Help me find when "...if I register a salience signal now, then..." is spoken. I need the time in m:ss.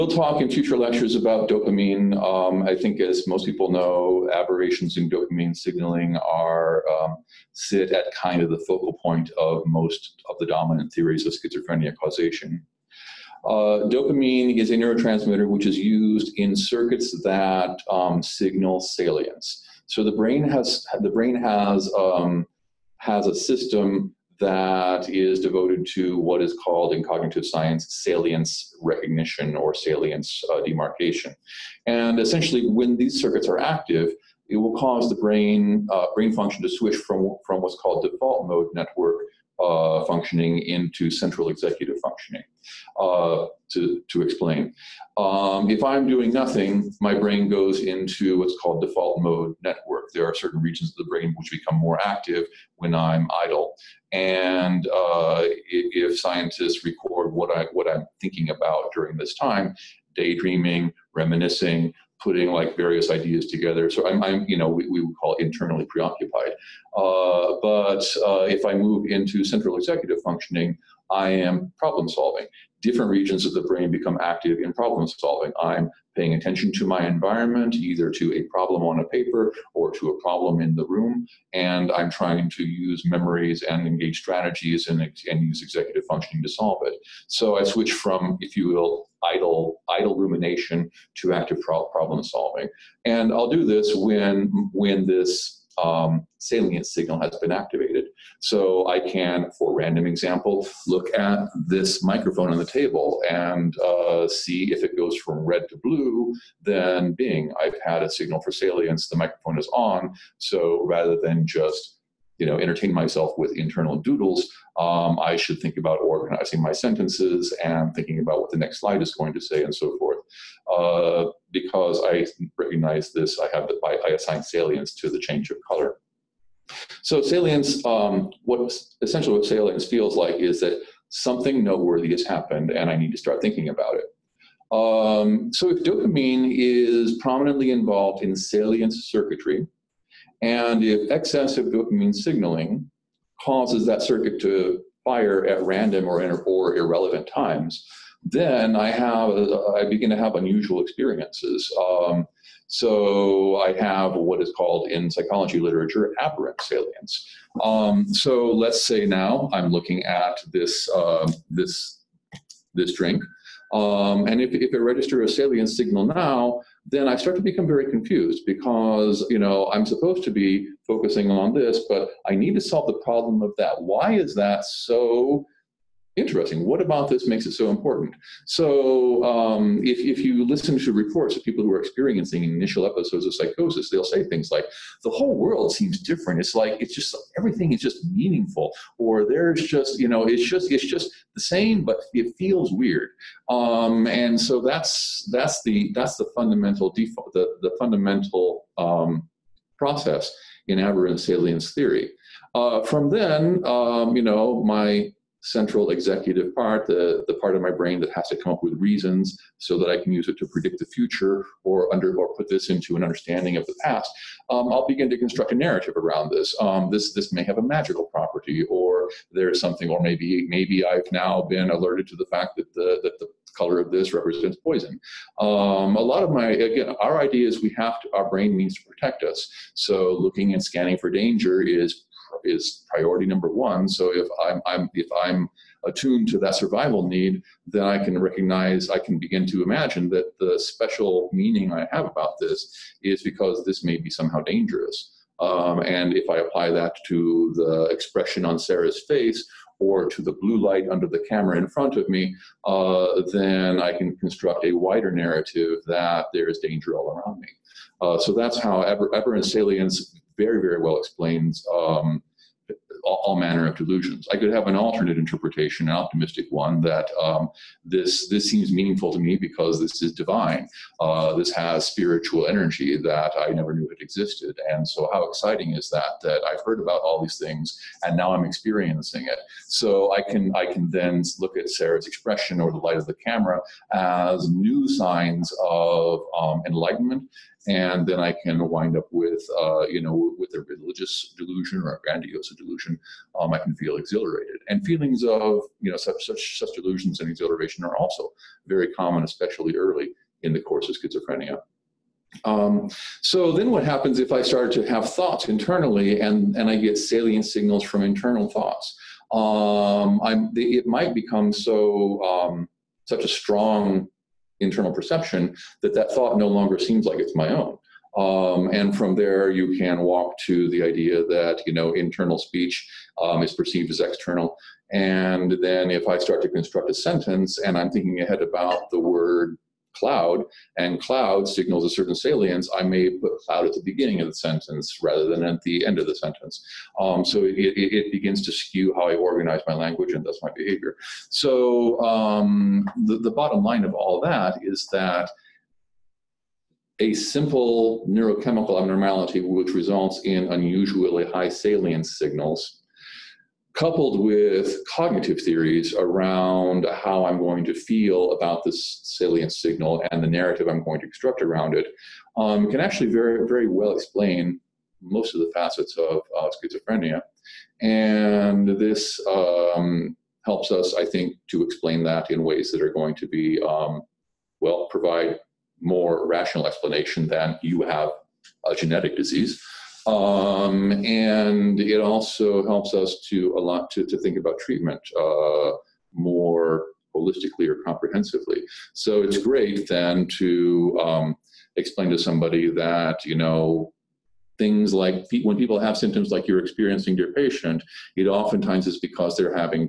2:44.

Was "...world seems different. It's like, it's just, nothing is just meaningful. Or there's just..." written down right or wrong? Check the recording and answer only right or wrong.
wrong.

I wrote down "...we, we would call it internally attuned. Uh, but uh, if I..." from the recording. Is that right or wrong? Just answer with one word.
wrong.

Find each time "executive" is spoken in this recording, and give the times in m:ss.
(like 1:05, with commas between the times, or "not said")
0:41, 1:09, 1:25, 3:25.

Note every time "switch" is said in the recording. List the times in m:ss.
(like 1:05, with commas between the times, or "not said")
0:36, 1:27.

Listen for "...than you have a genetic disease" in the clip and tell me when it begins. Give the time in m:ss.
6:17.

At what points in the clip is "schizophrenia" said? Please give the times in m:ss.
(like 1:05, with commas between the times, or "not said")
0:11, 5:00, 6:06.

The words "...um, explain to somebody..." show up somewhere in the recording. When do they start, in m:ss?
6:31.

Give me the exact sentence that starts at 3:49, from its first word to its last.
So looking and scanning for danger is is priority number one.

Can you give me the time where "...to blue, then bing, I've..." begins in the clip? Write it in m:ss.
1:45.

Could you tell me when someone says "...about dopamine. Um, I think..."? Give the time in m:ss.
0:01.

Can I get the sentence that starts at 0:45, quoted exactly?
Um, if I'm doing nothing, my brain goes into what's called default mode network.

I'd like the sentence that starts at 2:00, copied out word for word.
Uh, because I recognize this, I have the, I, I assign salience to the change of color.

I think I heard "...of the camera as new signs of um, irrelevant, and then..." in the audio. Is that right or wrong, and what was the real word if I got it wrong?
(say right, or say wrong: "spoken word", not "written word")
wrong: "enlightenment", not "irrelevant".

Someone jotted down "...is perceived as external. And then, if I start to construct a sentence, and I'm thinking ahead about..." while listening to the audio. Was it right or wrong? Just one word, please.
right.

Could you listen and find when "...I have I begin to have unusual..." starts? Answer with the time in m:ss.
2:28.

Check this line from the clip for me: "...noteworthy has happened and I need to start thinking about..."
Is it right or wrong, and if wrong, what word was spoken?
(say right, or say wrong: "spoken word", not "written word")
right.